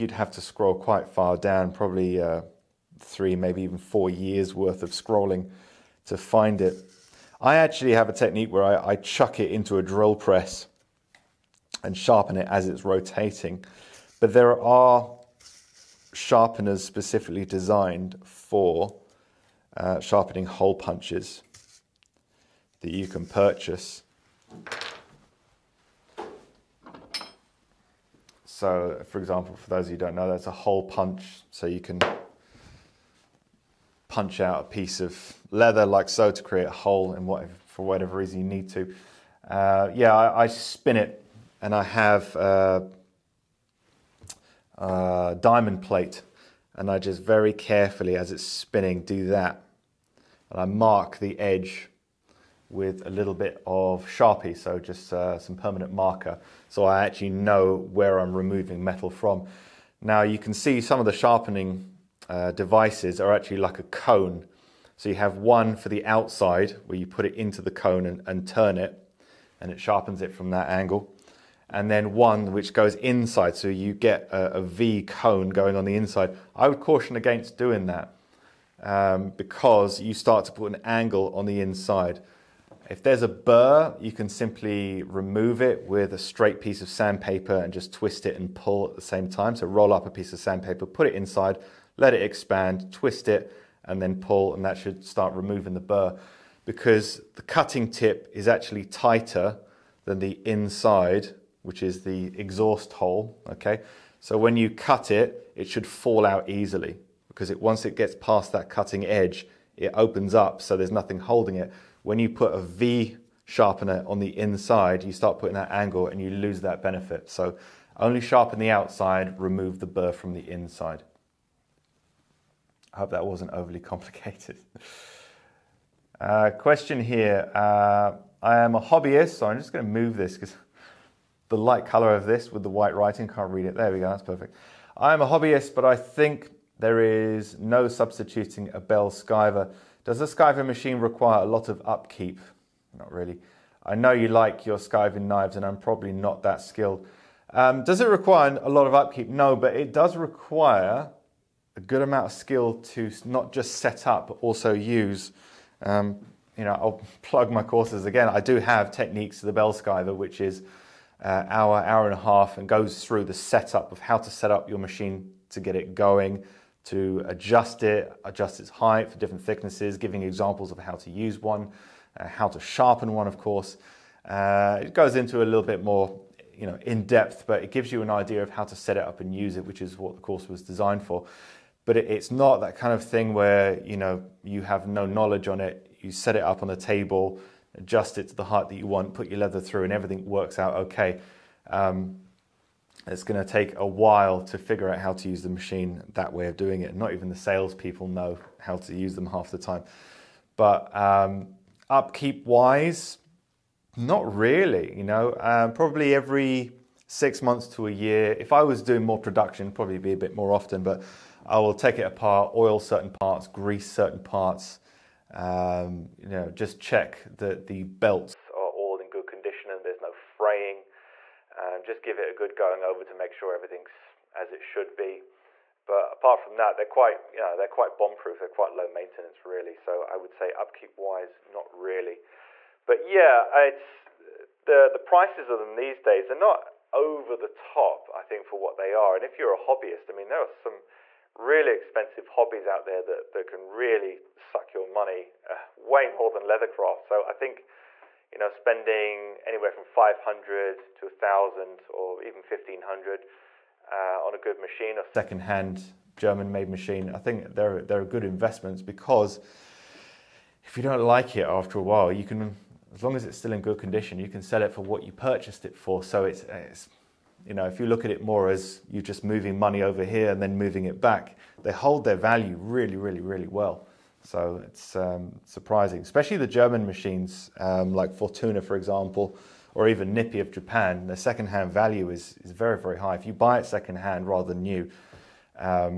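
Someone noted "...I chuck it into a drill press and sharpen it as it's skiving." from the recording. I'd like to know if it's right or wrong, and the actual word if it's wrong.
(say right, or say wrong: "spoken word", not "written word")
wrong: "rotating", not "skiving".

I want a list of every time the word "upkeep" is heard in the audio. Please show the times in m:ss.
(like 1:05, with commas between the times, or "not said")
2:21, 2:28, 3:21, 3:50.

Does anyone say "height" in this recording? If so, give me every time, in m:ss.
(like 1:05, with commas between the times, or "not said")
2:48, 3:08.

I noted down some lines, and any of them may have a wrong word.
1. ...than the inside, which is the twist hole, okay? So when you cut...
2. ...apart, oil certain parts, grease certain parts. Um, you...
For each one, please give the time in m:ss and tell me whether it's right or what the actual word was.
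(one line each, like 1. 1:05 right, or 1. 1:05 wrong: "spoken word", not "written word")
1. 1:40 wrong: "exhaust", not "twist"
2. 3:32 right.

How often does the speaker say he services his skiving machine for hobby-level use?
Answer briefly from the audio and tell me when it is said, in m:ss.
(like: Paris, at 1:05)
every 6 months to a year, at 3:26.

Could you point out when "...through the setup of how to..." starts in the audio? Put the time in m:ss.
2:43.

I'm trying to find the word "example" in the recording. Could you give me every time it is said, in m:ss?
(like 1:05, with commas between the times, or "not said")
0:29, 2:50, 4:38.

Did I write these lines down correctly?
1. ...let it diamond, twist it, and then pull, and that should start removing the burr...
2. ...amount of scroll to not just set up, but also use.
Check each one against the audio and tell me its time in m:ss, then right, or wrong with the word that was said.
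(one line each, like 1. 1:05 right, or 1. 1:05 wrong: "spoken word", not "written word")
1. 1:31 wrong: "expand", not "diamond"
2. 2:32 wrong: "skill", not "scroll".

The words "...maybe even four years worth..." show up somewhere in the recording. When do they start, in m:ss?
0:03.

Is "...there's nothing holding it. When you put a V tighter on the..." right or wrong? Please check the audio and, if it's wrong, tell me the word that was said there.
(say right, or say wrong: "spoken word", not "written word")
wrong: "sharpener", not "tighter".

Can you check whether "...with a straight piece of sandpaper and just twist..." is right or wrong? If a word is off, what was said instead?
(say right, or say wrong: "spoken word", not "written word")
right.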